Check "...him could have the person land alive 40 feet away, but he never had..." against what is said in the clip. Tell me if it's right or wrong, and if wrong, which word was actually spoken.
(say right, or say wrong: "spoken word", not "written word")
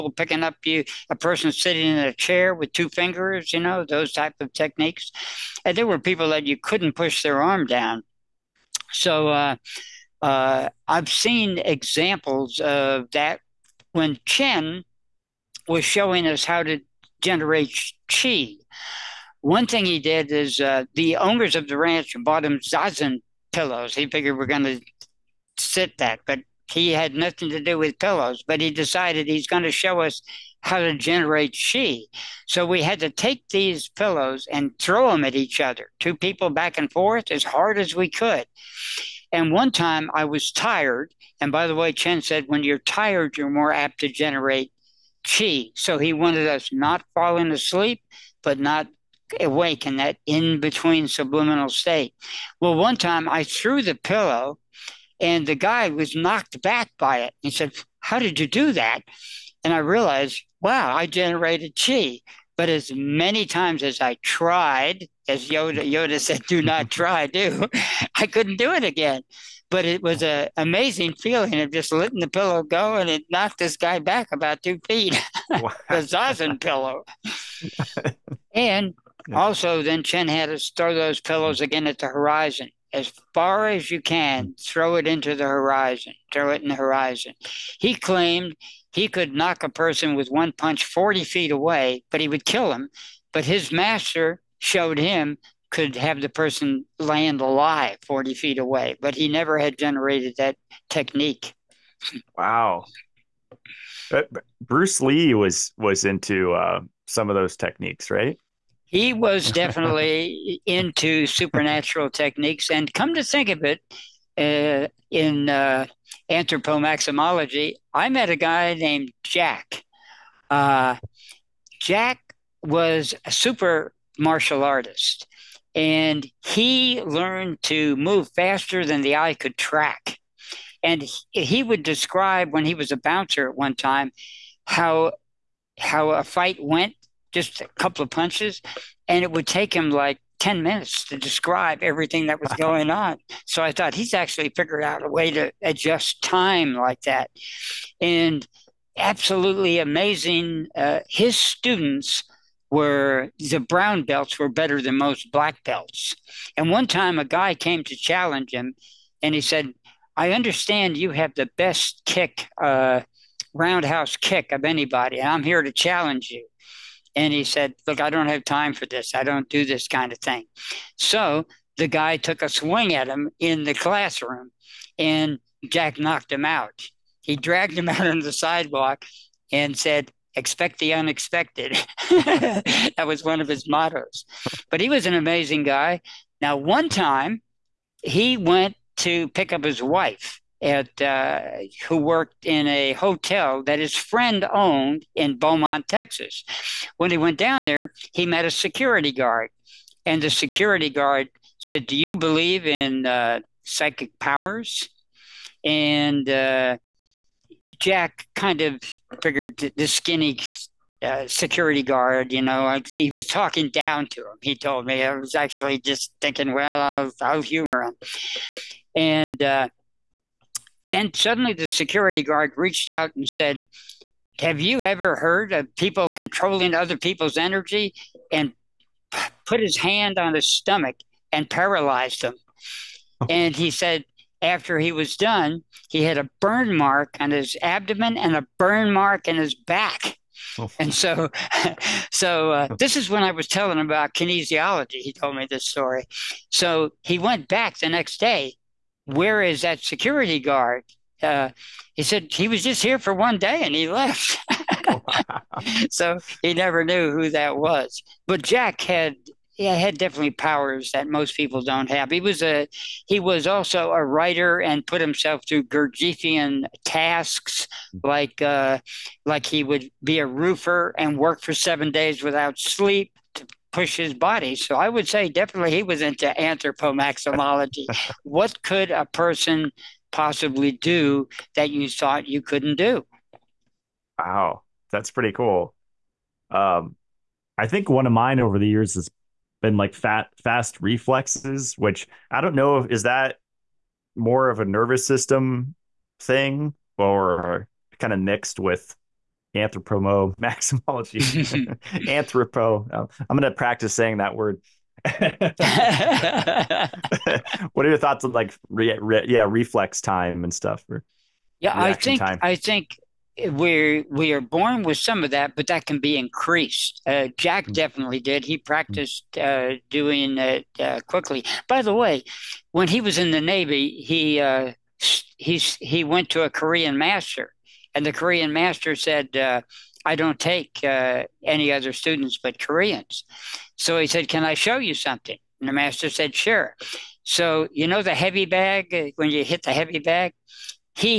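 right.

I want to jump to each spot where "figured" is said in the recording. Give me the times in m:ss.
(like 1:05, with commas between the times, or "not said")
0:24, 2:24, 3:29.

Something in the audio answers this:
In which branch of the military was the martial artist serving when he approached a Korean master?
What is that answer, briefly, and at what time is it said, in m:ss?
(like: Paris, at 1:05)
Navy, at 5:23.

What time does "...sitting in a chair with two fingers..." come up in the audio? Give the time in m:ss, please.
0:01.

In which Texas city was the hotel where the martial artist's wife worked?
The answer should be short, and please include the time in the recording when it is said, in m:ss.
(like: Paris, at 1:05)
Beaumont, at 3:15.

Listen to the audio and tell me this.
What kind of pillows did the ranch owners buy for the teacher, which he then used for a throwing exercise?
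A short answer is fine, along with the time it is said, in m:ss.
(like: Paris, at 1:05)
zazen pillows, at 0:22.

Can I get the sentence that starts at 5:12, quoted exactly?
i think we we are born with some of that, but that can be increased.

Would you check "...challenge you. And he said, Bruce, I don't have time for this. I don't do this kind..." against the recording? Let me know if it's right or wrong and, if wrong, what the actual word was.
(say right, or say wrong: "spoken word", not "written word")
wrong: "Look", not "Bruce".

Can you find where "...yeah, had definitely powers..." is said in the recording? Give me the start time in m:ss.
4:19.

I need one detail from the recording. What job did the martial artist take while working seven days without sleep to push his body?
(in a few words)
roofer.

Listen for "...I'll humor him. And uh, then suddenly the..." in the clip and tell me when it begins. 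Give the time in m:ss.
3:37.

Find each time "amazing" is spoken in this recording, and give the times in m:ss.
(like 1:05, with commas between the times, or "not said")
1:10, 2:29, 3:05.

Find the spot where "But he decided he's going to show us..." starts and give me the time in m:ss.
0:28.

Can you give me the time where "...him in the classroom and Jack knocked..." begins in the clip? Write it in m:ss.
2:53.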